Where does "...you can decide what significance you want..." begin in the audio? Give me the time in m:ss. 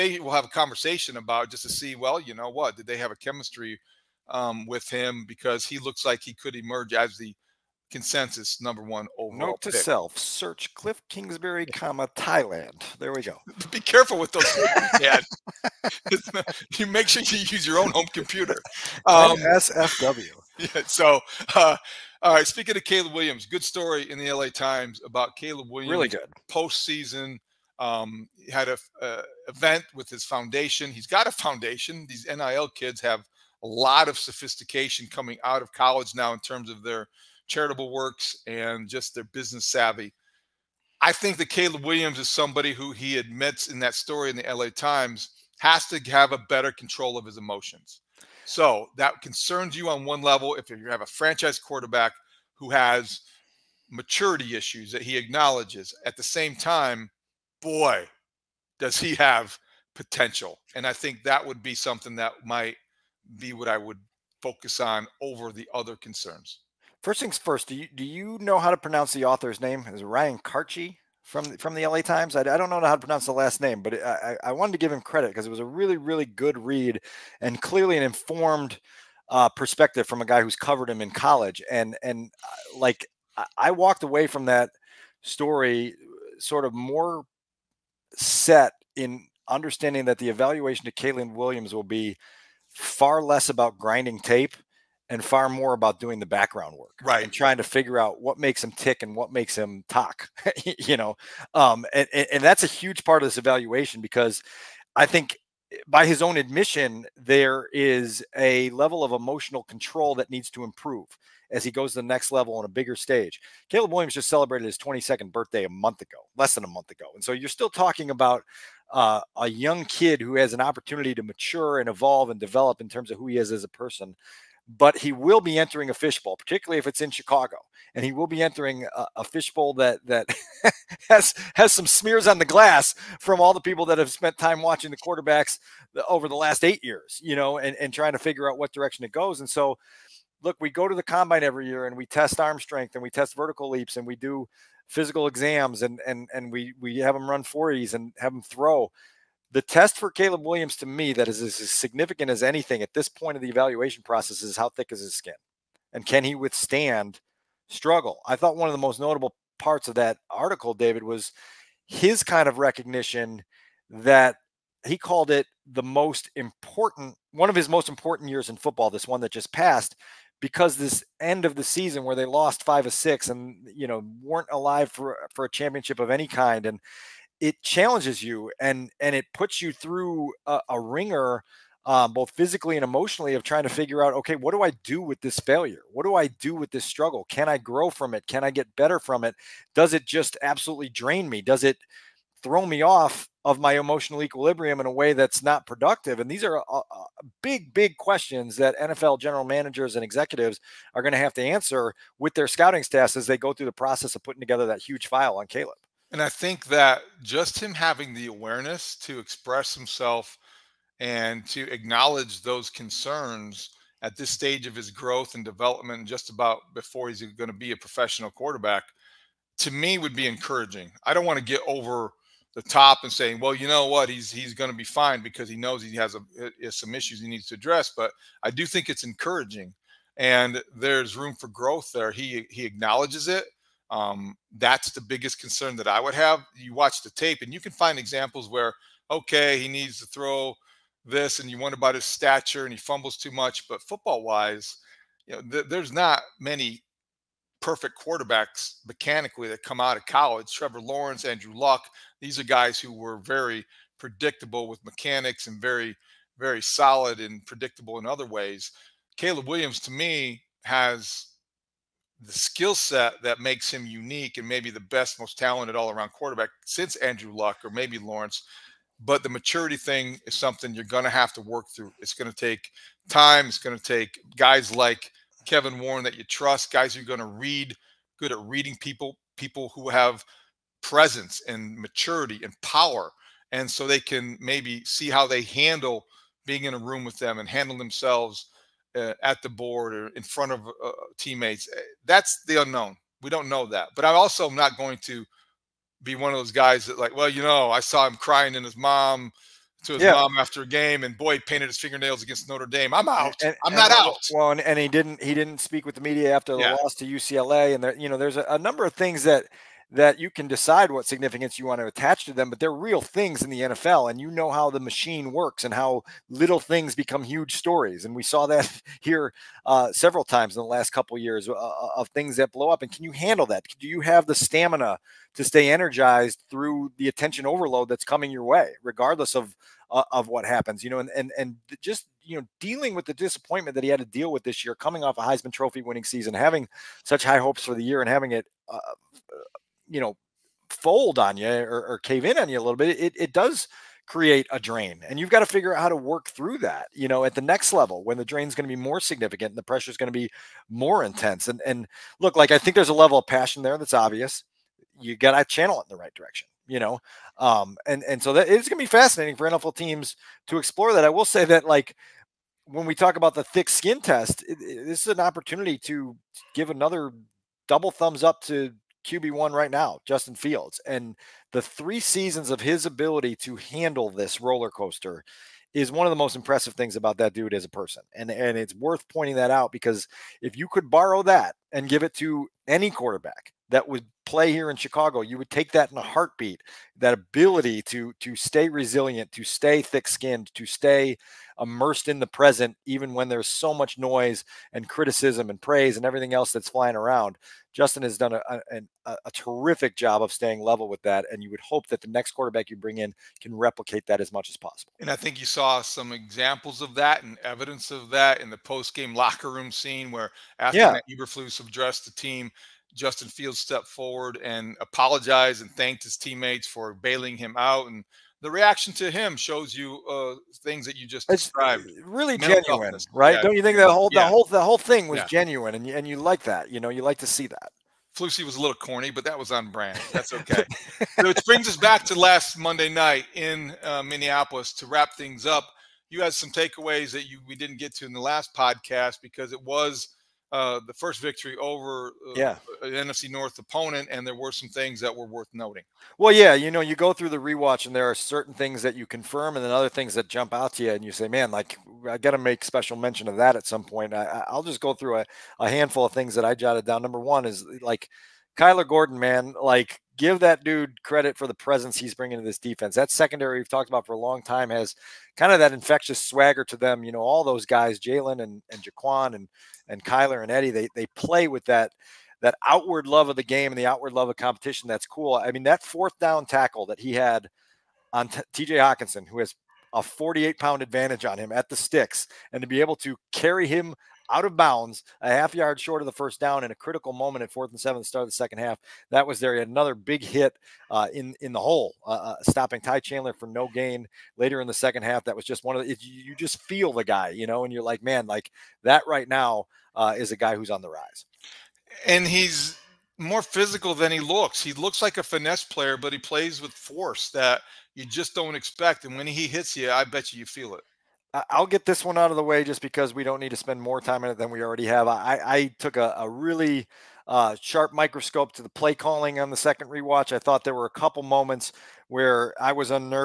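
5:10.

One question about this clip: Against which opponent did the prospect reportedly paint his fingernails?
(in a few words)
Notre Dame.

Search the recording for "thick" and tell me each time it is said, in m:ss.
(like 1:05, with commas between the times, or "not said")
2:34, 6:03, 6:29.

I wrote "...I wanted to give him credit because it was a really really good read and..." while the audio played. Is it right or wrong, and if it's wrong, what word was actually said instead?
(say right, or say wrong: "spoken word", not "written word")
right.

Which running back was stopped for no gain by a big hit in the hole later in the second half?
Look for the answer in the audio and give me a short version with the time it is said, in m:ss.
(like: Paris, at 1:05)
Ty Chandler, at 8:12.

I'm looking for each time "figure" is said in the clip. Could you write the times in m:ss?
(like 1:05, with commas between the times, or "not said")
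1:37, 2:18, 3:03, 5:45.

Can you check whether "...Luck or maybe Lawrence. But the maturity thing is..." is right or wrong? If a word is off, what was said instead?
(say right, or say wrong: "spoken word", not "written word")
right.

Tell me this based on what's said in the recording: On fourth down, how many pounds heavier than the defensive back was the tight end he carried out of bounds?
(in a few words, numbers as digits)
48.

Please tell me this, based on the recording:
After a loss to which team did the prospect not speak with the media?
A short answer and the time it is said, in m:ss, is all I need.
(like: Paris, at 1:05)
UCLA, at 5:07.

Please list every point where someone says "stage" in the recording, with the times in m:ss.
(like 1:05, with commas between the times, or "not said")
1:52, 3:34.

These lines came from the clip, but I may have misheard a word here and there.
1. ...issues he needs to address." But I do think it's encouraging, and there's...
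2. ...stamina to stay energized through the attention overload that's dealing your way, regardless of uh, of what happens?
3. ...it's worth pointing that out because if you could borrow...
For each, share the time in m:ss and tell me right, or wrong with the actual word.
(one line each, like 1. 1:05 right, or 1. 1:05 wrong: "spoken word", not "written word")
1. 3:46 right
2. 5:24 wrong: "coming", not "dealing"
3. 6:18 right.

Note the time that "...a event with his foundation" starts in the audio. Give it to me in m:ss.
0:28.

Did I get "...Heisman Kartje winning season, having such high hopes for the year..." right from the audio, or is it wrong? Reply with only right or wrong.
wrong.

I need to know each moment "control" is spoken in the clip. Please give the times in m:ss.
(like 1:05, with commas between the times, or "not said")
0:46, 1:49.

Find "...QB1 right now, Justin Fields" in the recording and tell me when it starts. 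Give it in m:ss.
6:09.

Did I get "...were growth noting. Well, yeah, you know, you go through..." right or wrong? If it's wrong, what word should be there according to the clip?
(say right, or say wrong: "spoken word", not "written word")
wrong: "worth", not "growth".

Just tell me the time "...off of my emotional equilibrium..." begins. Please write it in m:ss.
3:12.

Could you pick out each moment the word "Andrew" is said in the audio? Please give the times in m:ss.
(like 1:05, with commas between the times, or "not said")
4:11, 4:26.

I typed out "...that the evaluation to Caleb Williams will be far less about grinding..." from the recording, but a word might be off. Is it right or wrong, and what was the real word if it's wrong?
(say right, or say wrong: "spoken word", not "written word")
right.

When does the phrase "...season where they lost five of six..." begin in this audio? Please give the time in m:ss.
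2:51.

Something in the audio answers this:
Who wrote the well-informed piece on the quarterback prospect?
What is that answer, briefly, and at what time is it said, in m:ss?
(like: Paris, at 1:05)
Ryan Kartje, at 1:10.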